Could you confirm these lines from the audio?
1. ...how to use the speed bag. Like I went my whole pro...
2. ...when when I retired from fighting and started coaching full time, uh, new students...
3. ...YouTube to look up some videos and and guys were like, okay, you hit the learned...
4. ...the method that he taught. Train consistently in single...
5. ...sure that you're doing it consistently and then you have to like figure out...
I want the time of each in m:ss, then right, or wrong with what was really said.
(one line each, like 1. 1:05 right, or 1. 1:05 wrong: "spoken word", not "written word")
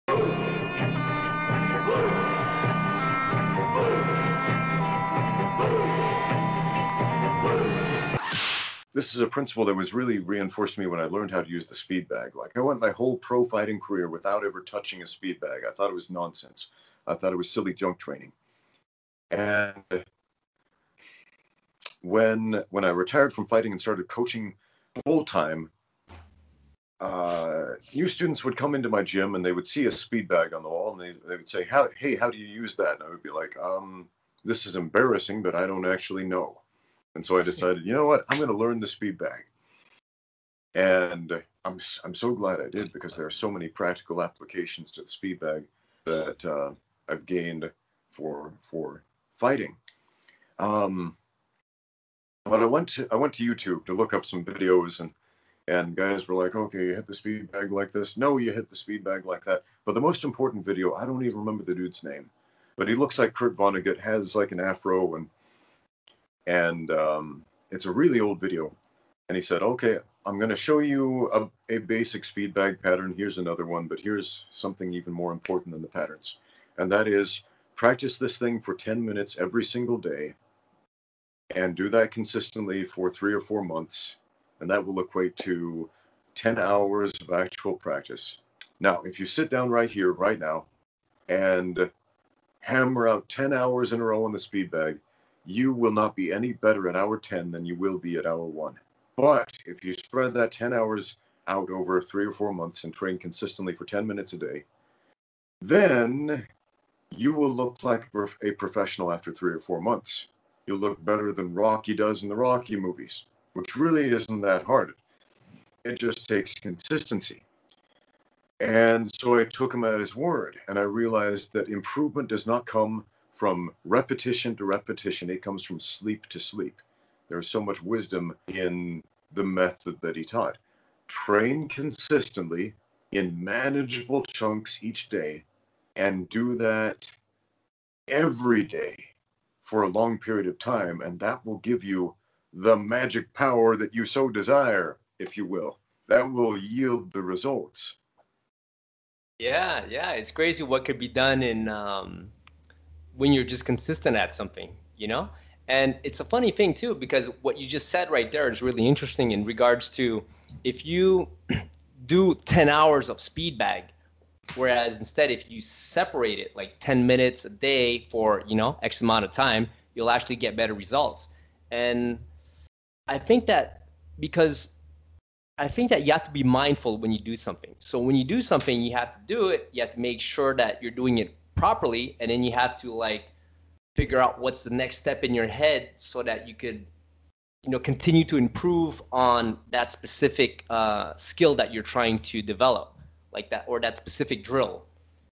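1. 0:11 right
2. 0:22 right
3. 0:53 wrong: "speed", not "learned"
4. 2:09 wrong: "manageable", not "single"
5. 3:00 wrong: "properly", not "consistently".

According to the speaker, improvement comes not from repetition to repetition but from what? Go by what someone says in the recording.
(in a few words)
Sleep to sleep.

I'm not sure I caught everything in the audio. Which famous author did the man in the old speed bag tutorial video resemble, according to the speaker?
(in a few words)
Kurt Vonnegut.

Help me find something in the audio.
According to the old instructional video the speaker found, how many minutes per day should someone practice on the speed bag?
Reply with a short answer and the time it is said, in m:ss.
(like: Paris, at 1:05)
10 minutes, at 1:18.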